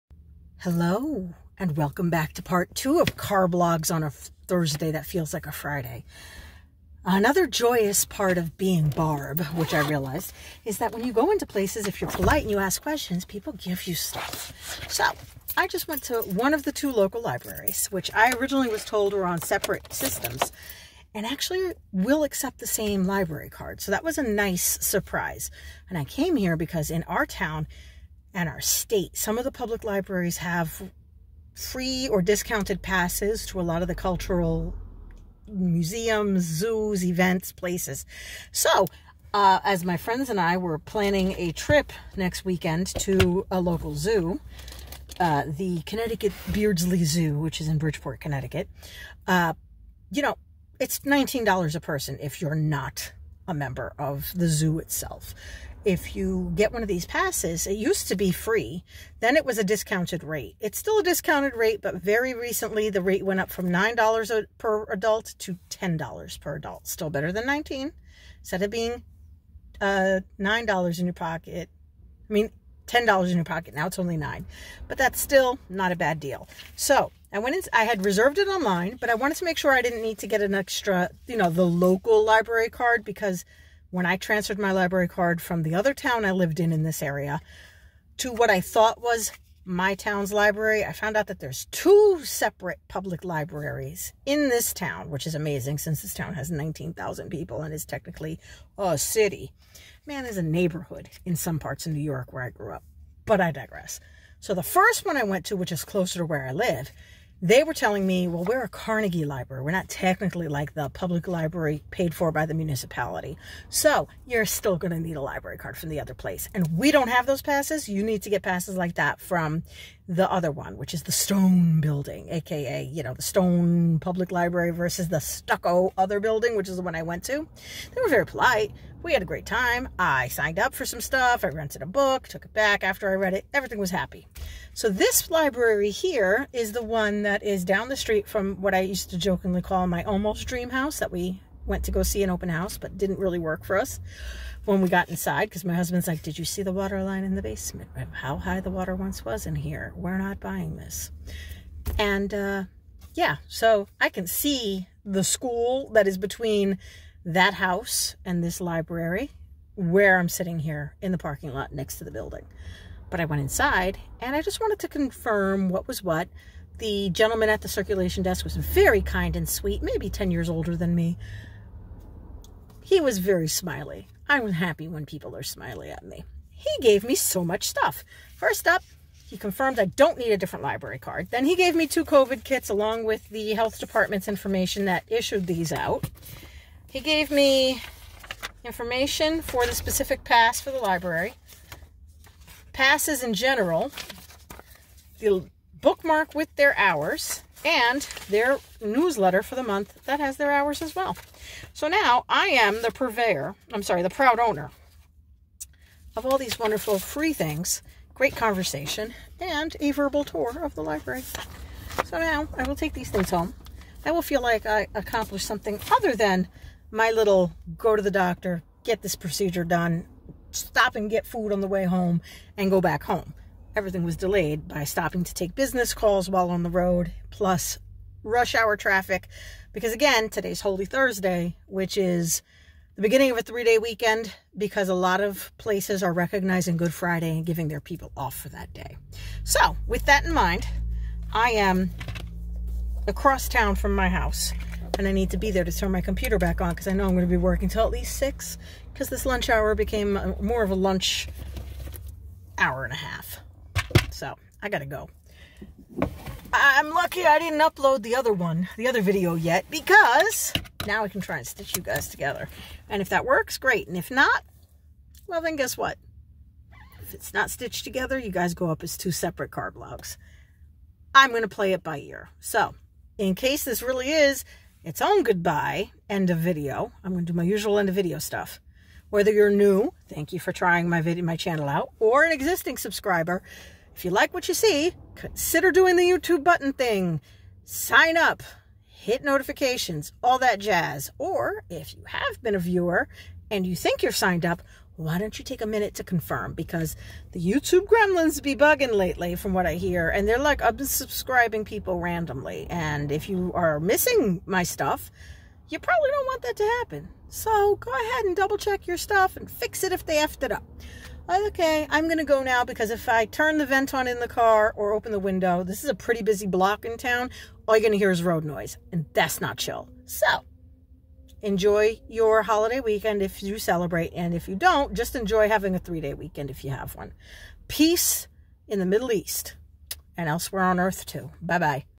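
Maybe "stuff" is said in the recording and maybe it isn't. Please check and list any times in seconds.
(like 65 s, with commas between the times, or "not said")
13 s, 130 s, 177 s, 278 s, 304 s, 308 s.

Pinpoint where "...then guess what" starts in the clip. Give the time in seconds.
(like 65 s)
265 s.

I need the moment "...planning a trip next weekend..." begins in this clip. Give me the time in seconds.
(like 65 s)
40 s.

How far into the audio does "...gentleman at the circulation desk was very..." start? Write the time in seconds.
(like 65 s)
167 s.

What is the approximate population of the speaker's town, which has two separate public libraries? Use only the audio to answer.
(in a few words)
19,000.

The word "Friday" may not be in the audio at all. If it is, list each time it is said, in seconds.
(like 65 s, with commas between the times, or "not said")
5 s, 236 s.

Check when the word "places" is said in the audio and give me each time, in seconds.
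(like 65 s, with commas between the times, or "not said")
11 s, 37 s, 116 s, 235 s.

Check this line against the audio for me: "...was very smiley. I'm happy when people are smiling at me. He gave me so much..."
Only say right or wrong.
right.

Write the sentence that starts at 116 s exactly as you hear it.
And we don't have those passes.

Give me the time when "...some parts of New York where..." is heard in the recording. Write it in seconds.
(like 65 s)
101 s.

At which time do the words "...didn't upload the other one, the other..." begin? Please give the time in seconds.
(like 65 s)
257 s.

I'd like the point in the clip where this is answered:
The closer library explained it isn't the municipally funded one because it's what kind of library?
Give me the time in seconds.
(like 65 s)
108 s.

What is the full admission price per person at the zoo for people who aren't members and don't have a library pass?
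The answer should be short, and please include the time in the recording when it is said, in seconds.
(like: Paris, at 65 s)
$19, at 50 s.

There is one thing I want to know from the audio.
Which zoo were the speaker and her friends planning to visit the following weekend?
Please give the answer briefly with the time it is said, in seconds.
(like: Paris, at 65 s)
Connecticut Beardsley Zoo, at 45 s.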